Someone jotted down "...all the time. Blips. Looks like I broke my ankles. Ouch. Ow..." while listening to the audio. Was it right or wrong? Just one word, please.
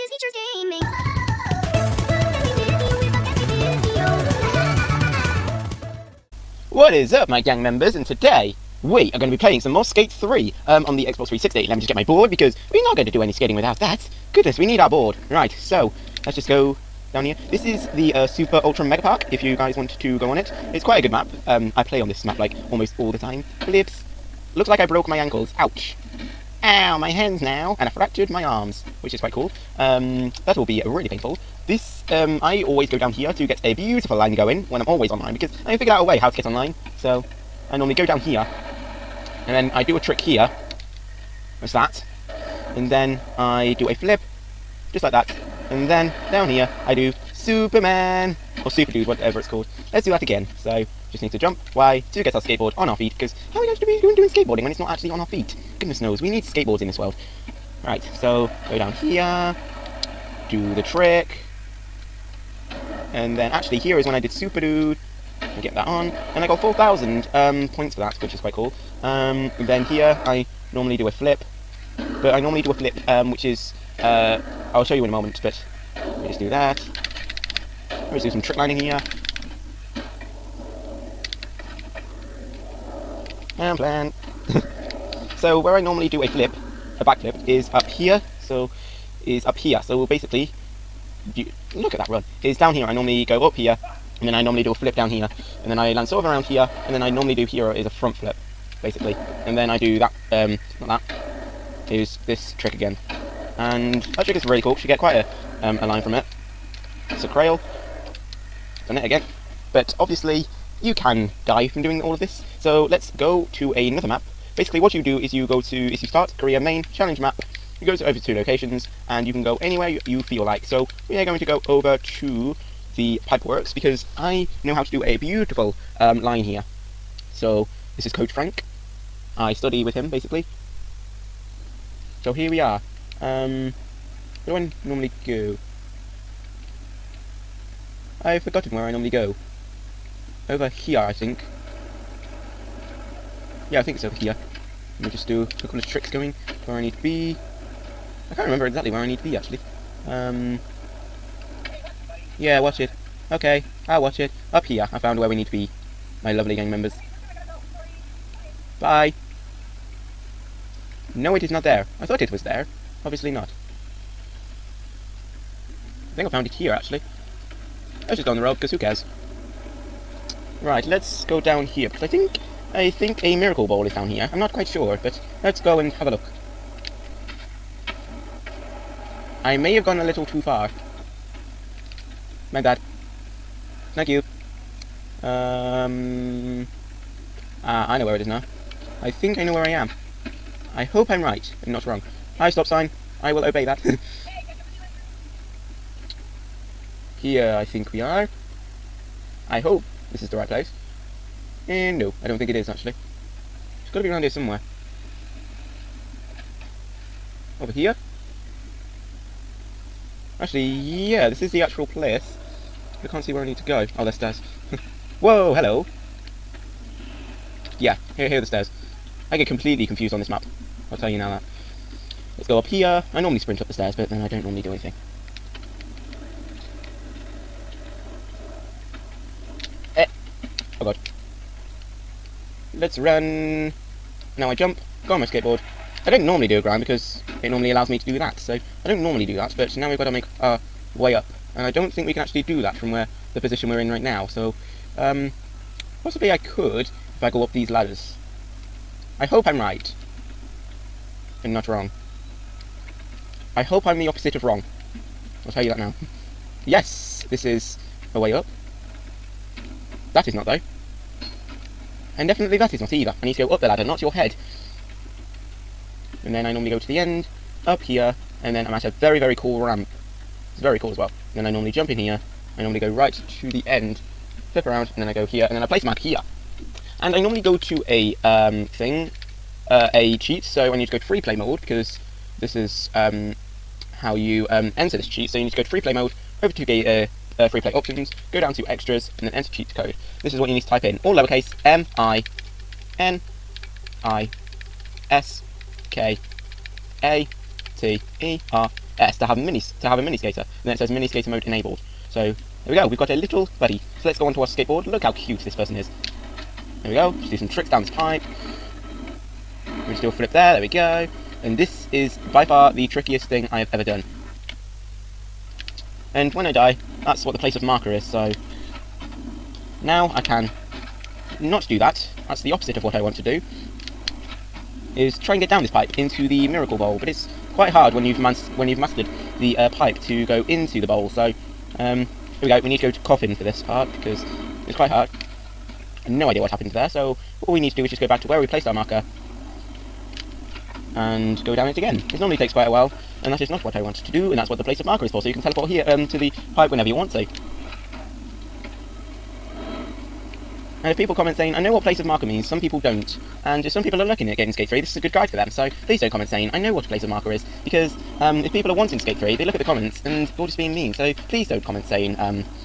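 right.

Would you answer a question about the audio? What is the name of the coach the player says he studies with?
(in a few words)
Coach Frank.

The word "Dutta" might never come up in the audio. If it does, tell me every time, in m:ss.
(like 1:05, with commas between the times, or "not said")
not said.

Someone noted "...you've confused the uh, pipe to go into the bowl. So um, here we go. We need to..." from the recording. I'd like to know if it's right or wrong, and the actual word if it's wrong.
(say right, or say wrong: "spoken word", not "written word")
wrong: "mastered", not "confused".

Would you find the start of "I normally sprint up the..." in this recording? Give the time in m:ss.
3:43.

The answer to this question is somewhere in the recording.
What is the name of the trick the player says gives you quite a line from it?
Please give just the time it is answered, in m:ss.
1:47.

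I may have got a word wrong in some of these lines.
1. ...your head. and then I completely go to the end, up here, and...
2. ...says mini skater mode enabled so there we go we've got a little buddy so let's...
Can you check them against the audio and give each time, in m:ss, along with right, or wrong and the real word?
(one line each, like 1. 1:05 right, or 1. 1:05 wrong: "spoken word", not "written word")
1. 4:24 wrong: "normally", not "completely"
2. 5:00 right.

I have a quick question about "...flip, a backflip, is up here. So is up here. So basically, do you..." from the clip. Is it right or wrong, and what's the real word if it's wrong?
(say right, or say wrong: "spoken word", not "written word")
right.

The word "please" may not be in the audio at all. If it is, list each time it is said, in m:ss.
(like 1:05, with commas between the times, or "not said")
5:55, 6:01.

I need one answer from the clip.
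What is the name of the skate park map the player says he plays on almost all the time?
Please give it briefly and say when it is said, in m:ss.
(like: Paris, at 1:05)
Super Ultra Mega Park, at 0:18.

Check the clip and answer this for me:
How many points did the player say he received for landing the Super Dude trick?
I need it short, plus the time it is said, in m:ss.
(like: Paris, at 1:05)
4,000, at 1:06.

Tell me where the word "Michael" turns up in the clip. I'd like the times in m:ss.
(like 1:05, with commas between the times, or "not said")
not said.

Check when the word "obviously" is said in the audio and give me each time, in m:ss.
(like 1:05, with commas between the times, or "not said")
1:49, 2:43.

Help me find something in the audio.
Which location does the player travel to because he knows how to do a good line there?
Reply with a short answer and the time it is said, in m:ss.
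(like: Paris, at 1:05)
the pipeworks, at 2:02.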